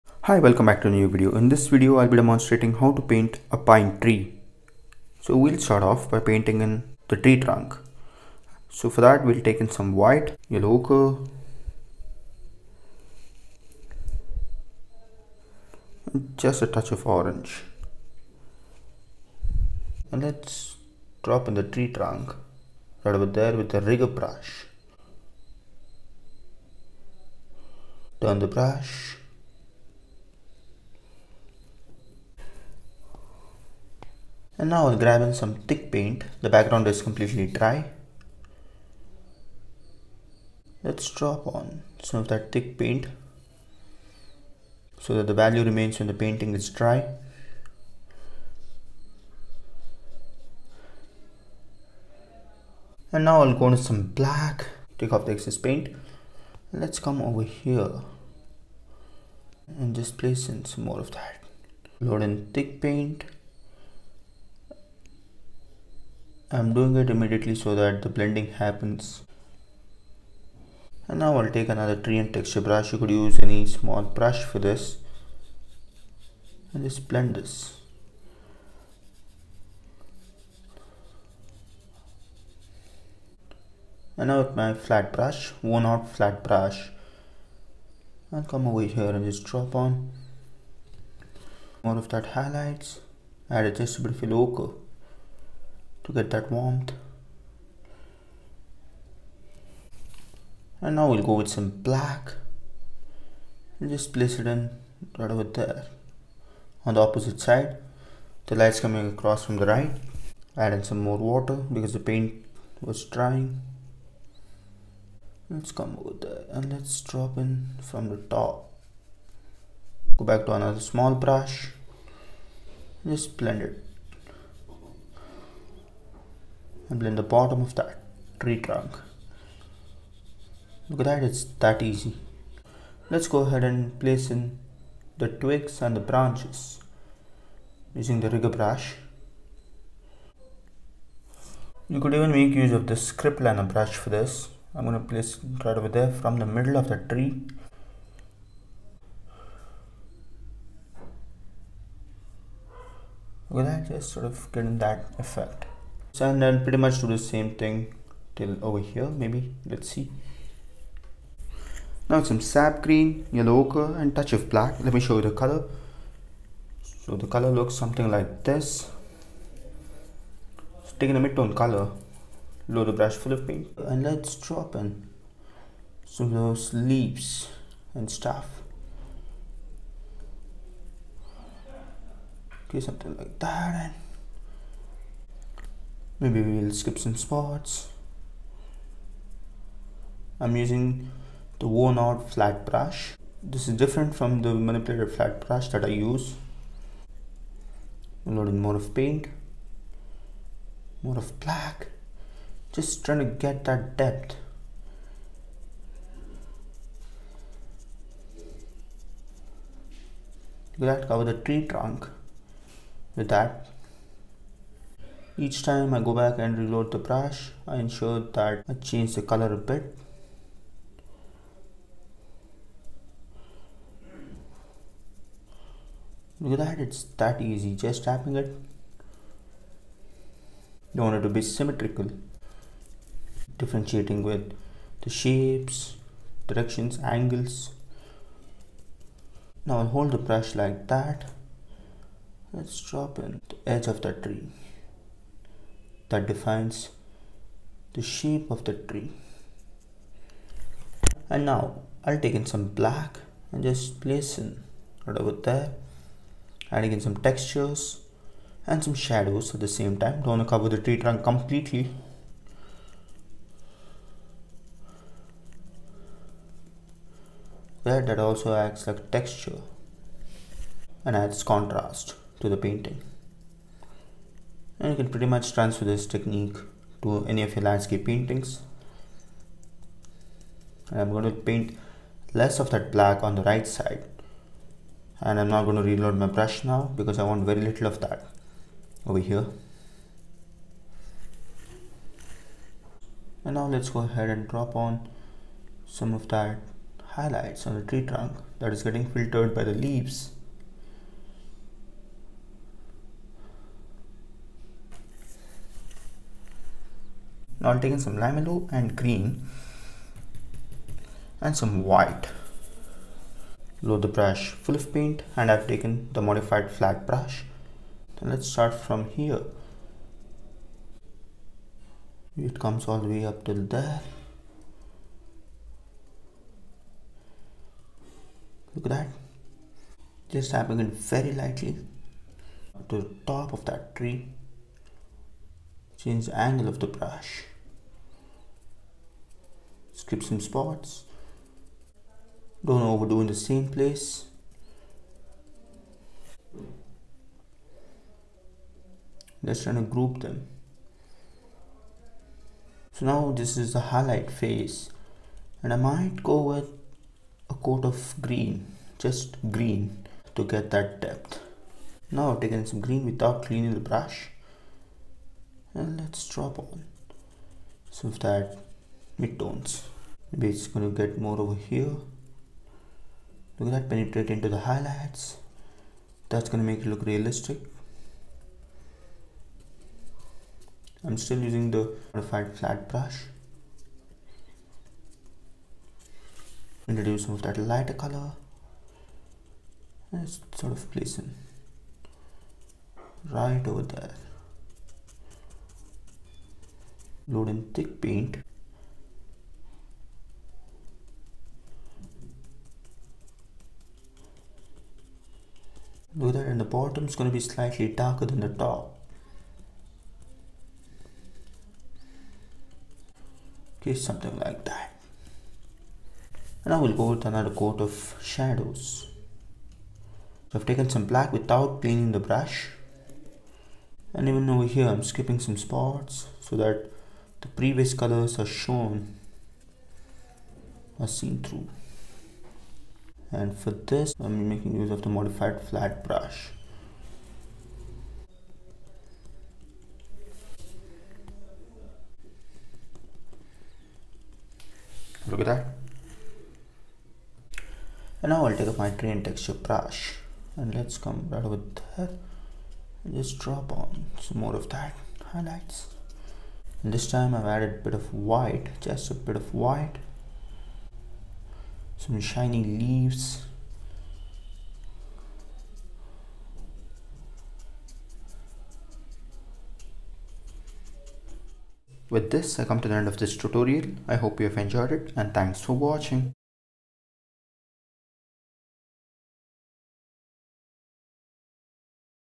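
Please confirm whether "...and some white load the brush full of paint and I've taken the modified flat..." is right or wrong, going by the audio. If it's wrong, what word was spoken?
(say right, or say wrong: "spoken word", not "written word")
right.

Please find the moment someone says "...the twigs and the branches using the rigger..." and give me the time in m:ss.
2:15.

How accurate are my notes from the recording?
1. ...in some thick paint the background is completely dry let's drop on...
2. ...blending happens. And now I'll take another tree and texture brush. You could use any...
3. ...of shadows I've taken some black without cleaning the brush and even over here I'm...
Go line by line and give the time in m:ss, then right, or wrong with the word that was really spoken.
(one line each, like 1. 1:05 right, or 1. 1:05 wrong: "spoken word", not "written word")
1. 0:35 right
2. 1:08 right
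3. 6:57 right.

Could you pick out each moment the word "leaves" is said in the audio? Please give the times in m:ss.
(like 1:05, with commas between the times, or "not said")
2:56, 4:59, 7:42.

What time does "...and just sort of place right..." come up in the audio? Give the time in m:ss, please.
6:30.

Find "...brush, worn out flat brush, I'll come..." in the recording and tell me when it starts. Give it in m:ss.
1:25.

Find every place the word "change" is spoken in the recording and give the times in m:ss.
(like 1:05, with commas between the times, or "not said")
3:38, 5:36.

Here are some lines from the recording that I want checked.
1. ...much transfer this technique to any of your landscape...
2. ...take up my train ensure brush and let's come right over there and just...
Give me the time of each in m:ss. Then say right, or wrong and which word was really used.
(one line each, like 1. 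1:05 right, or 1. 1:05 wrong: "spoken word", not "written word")
1. 4:35 right
2. 7:28 wrong: "texture", not "ensure".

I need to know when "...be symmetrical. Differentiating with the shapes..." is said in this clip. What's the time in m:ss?
3:51.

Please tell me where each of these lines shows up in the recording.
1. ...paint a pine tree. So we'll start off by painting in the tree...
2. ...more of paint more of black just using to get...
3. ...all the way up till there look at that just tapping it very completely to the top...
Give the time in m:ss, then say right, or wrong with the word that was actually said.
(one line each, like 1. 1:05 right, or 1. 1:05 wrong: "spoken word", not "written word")
1. 0:03 right
2. 3:18 wrong: "trying", not "using"
3. 5:22 wrong: "lightly", not "completely".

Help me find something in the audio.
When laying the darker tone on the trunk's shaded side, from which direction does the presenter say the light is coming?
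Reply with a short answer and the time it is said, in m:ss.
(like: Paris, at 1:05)
From the right, at 1:49.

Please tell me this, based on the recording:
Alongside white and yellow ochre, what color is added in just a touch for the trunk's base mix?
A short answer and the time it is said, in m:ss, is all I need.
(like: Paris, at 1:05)
Orange, at 0:17.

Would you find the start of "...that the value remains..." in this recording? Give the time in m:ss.
0:45.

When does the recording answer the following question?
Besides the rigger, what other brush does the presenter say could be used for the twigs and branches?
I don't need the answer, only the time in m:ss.
2:23.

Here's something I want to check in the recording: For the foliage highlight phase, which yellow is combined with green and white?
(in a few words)
Lime yellow.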